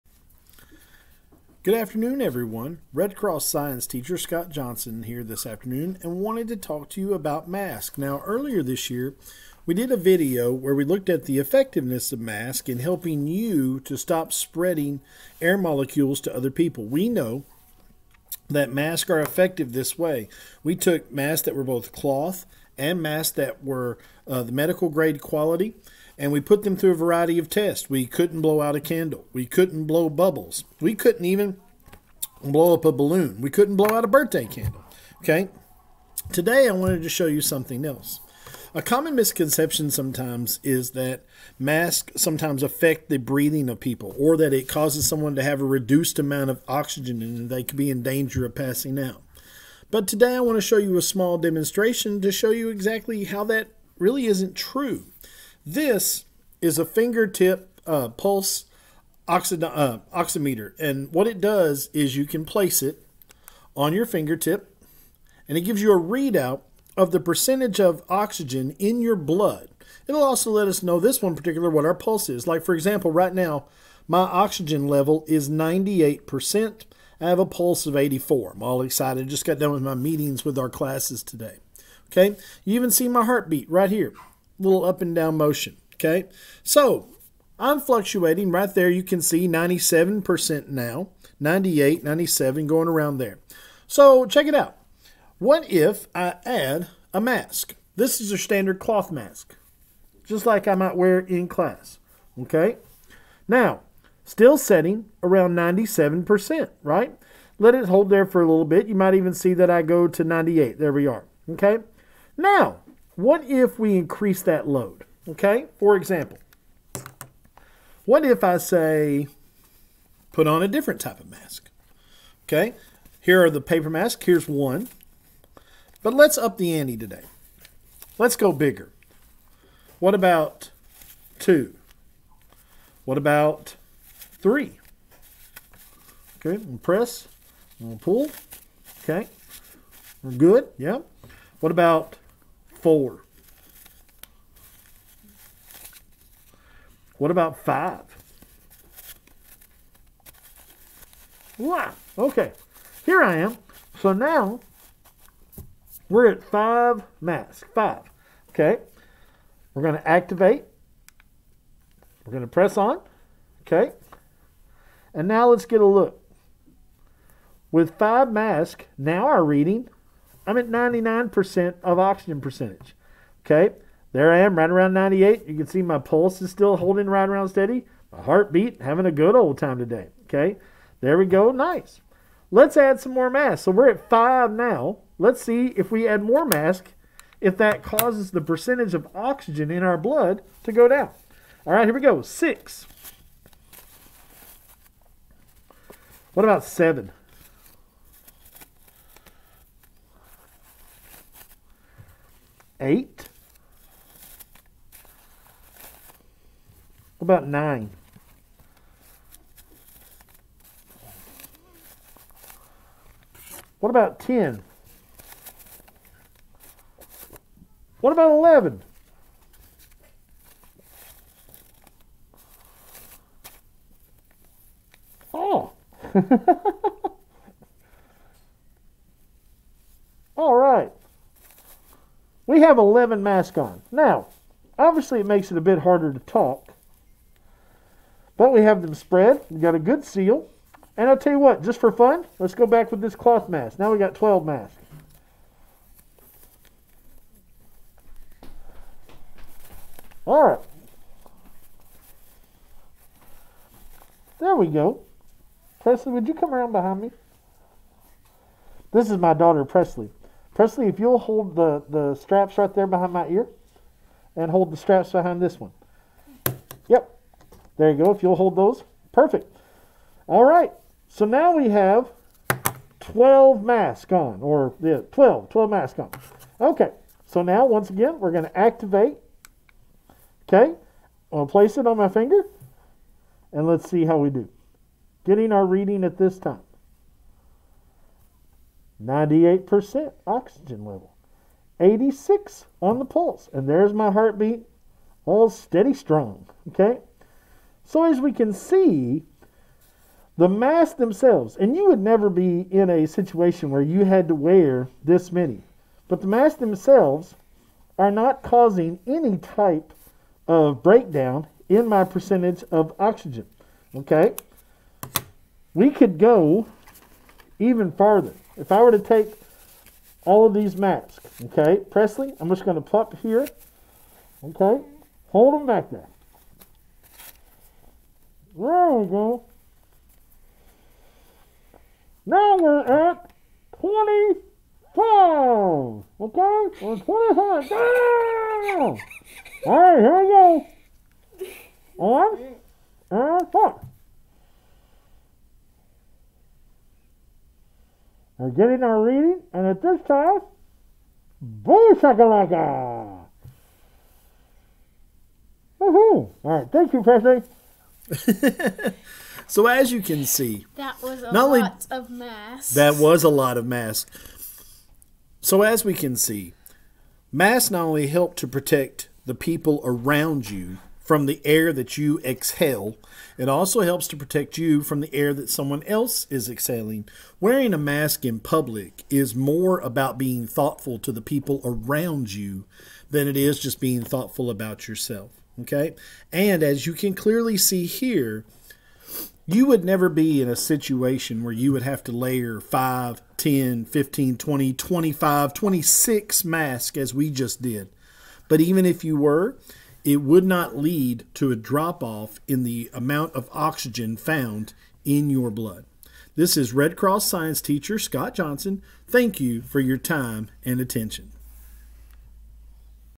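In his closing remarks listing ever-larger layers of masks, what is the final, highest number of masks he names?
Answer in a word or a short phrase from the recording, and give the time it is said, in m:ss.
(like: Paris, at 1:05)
26, at 6:35.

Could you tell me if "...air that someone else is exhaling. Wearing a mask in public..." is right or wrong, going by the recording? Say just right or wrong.
right.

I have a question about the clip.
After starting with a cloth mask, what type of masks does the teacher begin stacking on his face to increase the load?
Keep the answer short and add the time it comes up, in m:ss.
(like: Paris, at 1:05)
paper masks, at 2:03.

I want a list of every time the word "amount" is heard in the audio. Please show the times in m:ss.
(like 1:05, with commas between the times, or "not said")
0:46, 6:42.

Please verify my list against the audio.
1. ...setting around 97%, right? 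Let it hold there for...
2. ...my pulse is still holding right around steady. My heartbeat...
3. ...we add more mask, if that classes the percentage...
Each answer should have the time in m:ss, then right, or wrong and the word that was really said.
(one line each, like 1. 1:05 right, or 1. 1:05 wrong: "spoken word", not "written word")
1. 1:44 right
2. 2:55 right
3. 3:05 wrong: "causes", not "classes".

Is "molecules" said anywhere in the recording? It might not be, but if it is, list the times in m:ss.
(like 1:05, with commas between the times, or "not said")
0:15.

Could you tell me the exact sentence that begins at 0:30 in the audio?
We couldn't even blow up a balloon.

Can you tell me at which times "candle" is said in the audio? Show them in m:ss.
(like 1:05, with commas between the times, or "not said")
0:28, 0:34.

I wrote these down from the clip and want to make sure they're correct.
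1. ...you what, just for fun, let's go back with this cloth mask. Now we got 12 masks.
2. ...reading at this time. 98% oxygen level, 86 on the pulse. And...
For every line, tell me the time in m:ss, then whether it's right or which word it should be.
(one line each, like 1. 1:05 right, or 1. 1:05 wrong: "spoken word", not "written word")
1. 4:01 right
2. 4:45 right.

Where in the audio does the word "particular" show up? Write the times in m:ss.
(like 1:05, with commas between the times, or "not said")
1:11.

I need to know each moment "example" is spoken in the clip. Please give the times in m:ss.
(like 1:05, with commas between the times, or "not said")
1:12, 1:55.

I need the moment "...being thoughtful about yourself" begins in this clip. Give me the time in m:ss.
6:23.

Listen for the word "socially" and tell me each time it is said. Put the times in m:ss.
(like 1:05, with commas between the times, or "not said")
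not said.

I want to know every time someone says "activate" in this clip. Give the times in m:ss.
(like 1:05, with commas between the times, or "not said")
2:40, 4:38.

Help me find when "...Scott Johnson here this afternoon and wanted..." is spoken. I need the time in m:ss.
0:04.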